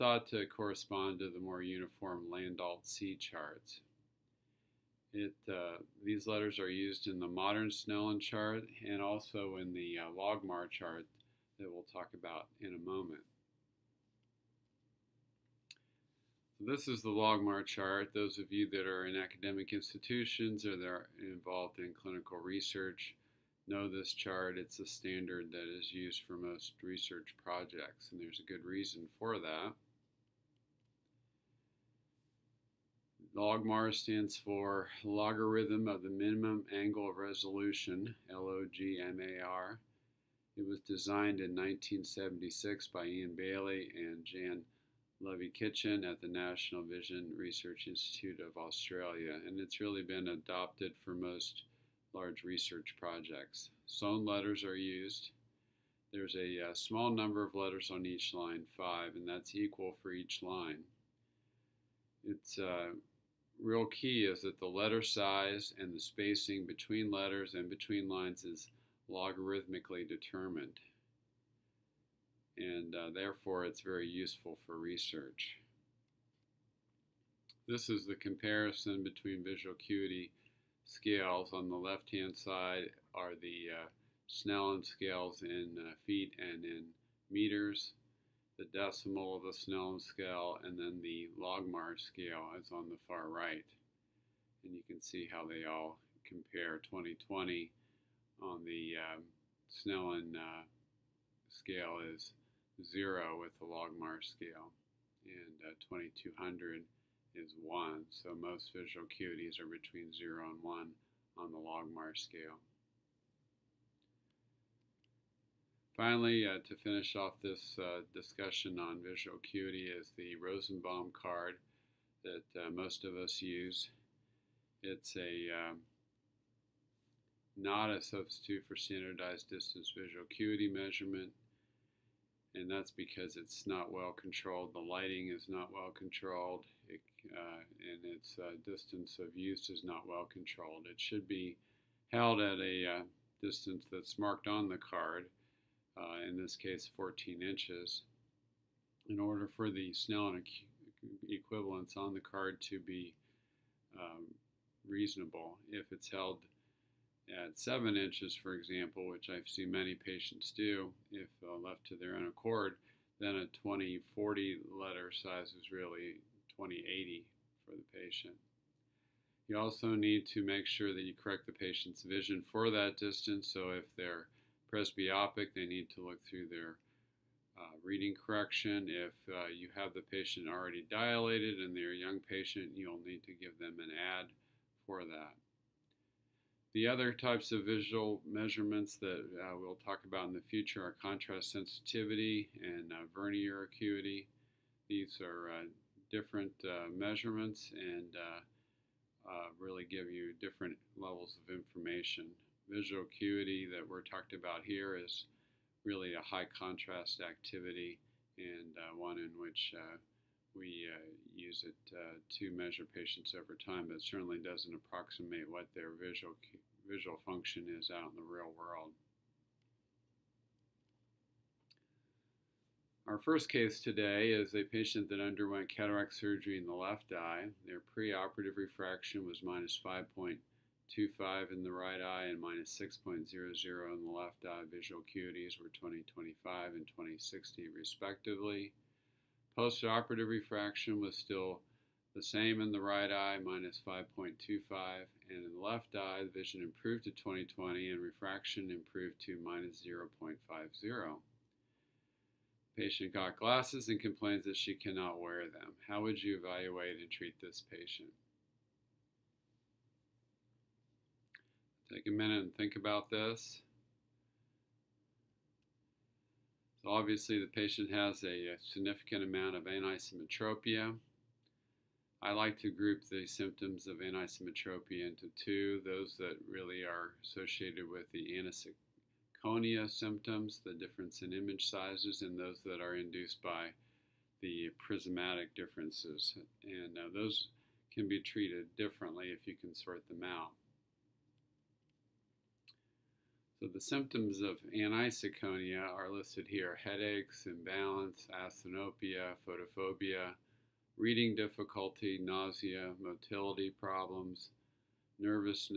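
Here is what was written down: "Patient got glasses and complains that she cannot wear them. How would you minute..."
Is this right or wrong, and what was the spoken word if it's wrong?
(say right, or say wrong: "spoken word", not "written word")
wrong: "evaluate", not "minute".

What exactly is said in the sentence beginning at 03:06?
The other types of visual measurements that uh, we'll talk about in the future are contrast sensitivity and uh, vernier acuity.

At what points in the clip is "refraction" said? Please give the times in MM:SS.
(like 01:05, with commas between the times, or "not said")
03:48, 04:00, 04:08.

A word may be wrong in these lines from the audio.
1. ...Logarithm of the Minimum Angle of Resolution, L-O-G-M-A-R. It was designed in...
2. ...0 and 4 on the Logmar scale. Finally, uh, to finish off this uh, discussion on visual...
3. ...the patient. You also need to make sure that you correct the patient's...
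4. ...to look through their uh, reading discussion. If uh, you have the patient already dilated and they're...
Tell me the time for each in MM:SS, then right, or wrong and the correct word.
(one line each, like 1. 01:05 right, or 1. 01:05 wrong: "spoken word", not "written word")
1. 00:35 right
2. 01:50 wrong: "1", not "4"
3. 02:47 right
4. 02:55 wrong: "correction", not "discussion".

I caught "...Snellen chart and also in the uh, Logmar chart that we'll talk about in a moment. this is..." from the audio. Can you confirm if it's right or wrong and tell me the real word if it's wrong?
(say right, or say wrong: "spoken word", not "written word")
right.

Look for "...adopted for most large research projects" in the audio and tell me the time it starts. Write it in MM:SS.
00:50.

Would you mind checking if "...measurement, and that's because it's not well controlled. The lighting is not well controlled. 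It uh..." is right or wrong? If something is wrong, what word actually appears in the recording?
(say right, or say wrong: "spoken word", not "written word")
right.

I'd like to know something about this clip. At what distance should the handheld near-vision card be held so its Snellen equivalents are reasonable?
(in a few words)
14 inches.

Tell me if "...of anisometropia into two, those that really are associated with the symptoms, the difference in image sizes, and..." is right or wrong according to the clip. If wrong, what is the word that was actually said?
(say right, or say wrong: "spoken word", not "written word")
right.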